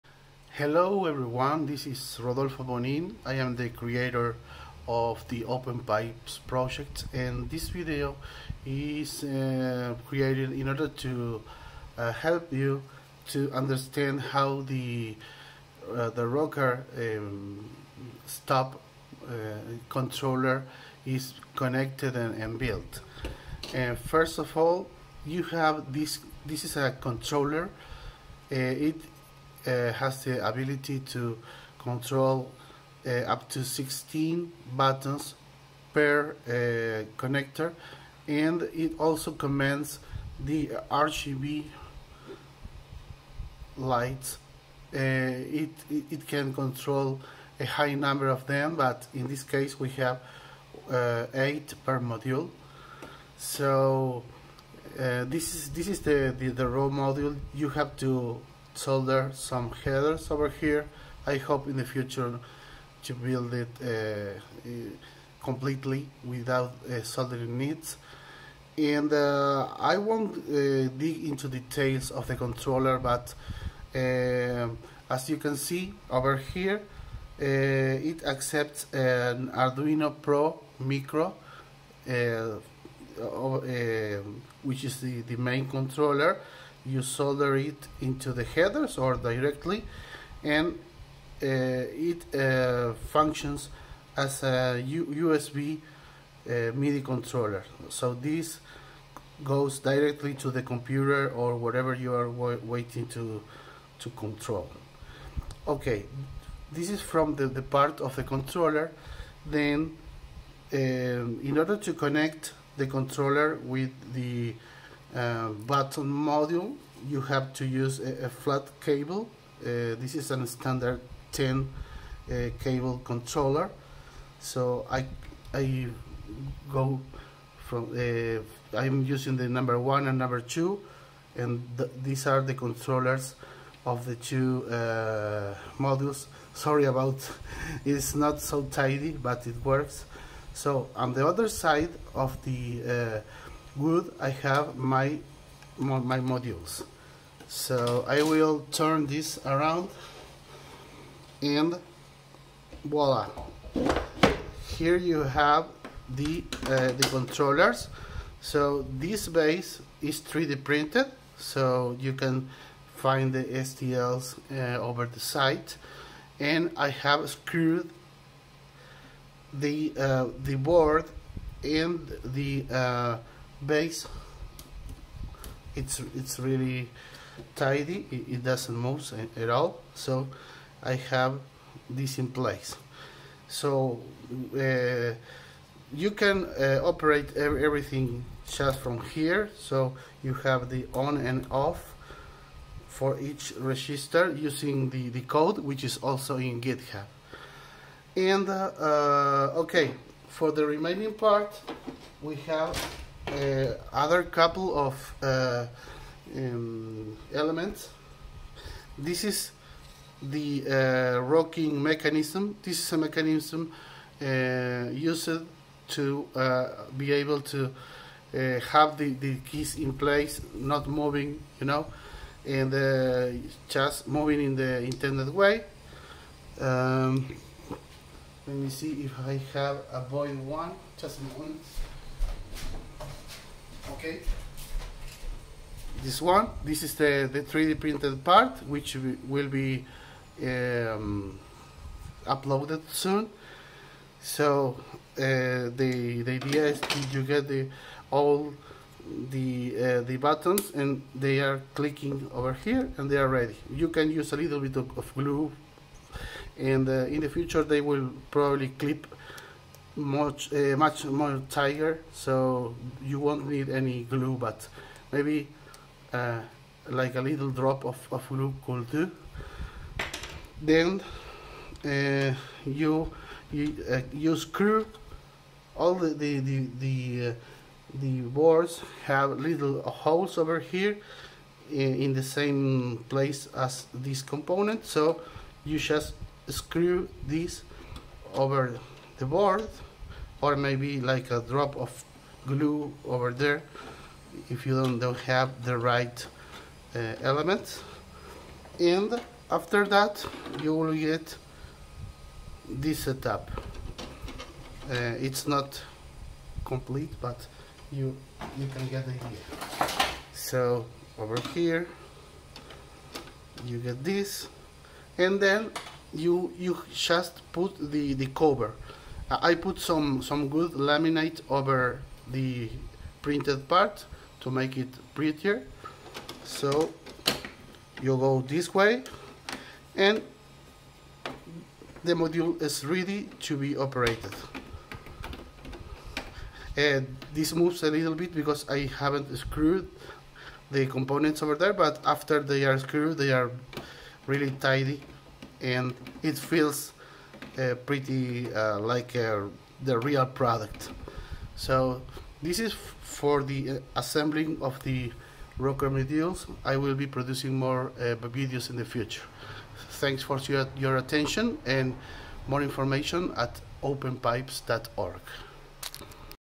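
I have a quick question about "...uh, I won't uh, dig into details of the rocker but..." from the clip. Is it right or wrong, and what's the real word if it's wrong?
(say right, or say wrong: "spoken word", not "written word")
wrong: "controller", not "rocker".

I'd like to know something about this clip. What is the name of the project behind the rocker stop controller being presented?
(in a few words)
Open Pipes.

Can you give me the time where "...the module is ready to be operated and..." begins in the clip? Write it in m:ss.
5:32.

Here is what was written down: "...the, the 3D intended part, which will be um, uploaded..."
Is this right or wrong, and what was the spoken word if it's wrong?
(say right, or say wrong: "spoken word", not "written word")
wrong: "printed", not "intended".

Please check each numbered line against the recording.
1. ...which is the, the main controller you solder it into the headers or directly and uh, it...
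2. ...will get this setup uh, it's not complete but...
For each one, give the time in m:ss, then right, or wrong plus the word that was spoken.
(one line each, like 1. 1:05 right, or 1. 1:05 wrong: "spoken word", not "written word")
1. 1:24 right
2. 5:00 right.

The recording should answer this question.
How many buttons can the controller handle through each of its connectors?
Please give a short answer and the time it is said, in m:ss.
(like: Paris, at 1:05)
16, at 0:33.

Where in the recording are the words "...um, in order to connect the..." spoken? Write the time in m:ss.
1:50.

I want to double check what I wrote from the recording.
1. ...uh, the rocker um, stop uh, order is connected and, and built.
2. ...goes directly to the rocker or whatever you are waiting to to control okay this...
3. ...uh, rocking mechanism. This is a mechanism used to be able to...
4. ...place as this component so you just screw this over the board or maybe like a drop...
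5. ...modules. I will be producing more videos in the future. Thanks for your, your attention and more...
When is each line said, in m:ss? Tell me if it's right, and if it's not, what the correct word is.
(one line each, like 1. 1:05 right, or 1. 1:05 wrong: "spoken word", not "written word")
1. 0:15 wrong: "controller", not "order"
2. 1:39 wrong: "computer", not "rocker"
3. 3:30 right
4. 4:43 right
5. 5:55 right.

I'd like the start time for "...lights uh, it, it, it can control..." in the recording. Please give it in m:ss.
0:43.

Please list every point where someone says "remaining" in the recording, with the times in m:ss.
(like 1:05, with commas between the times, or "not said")
3:20.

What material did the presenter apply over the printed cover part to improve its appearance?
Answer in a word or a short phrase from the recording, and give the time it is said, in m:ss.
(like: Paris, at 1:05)
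laminate, at 5:20.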